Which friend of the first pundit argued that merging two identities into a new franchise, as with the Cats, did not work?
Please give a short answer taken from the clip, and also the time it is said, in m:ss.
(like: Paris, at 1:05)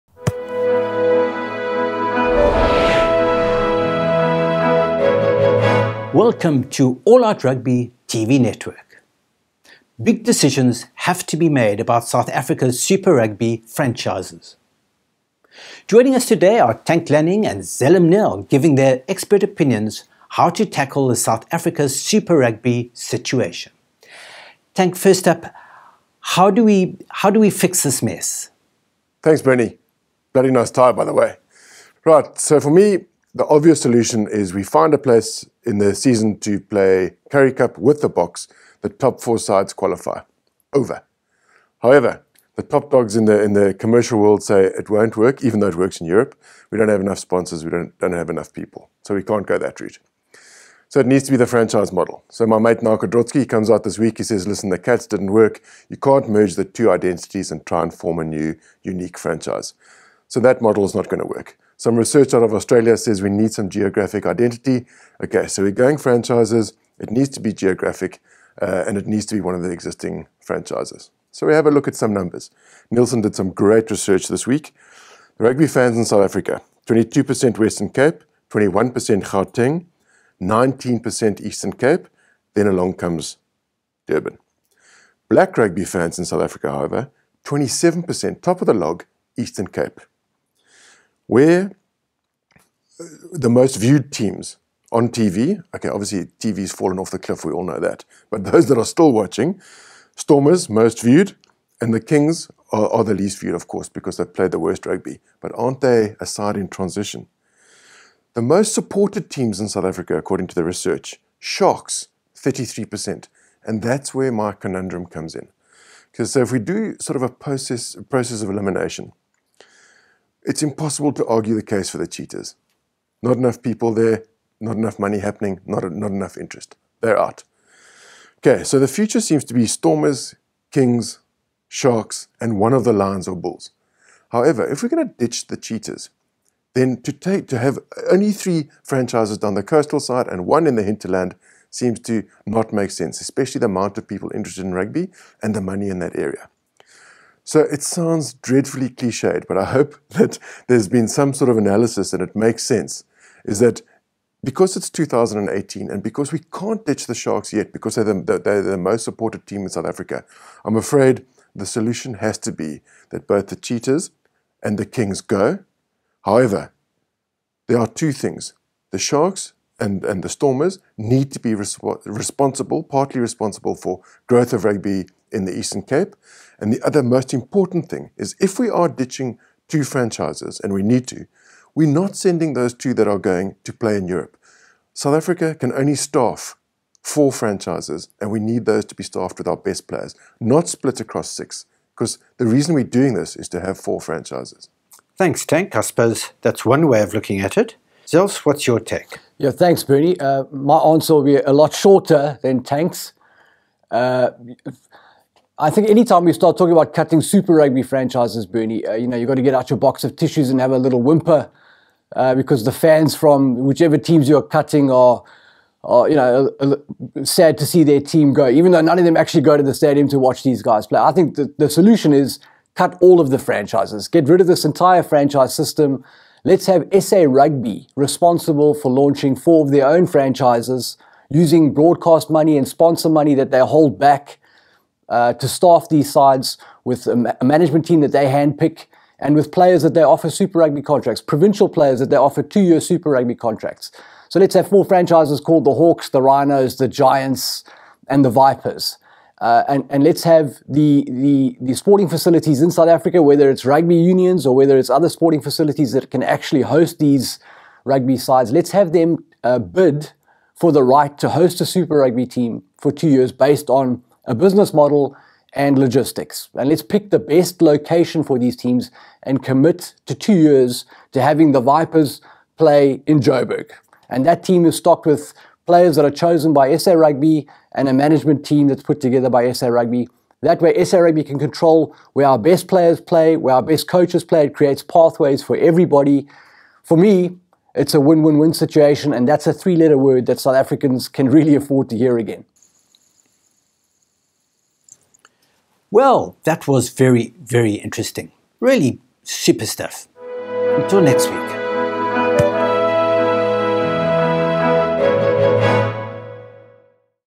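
Marko Drotsky, at 0:52.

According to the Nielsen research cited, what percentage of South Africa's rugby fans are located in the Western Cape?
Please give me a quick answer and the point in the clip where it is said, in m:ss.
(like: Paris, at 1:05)
22%, at 1:16.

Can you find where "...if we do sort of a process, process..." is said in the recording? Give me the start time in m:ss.
1:56.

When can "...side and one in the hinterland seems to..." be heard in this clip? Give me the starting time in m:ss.
2:19.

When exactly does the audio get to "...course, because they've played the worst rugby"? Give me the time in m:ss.
1:43.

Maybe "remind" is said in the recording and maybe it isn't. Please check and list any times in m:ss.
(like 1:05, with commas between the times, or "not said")
not said.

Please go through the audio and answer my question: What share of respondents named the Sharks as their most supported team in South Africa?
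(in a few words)
33%.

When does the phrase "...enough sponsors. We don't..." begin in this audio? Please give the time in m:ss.
0:46.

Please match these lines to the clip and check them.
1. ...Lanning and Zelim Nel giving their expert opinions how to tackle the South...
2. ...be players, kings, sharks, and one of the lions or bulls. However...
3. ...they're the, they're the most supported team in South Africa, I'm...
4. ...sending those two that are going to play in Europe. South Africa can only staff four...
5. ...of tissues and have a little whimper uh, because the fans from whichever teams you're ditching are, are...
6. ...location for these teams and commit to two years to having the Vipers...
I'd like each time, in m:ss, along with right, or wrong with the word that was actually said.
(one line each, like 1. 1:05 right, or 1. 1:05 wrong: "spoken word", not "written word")
1. 0:17 right
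2. 2:09 wrong: "stormers", not "players"
3. 2:37 right
4. 3:02 right
5. 3:30 wrong: "cutting", not "ditching"
6. 4:27 right.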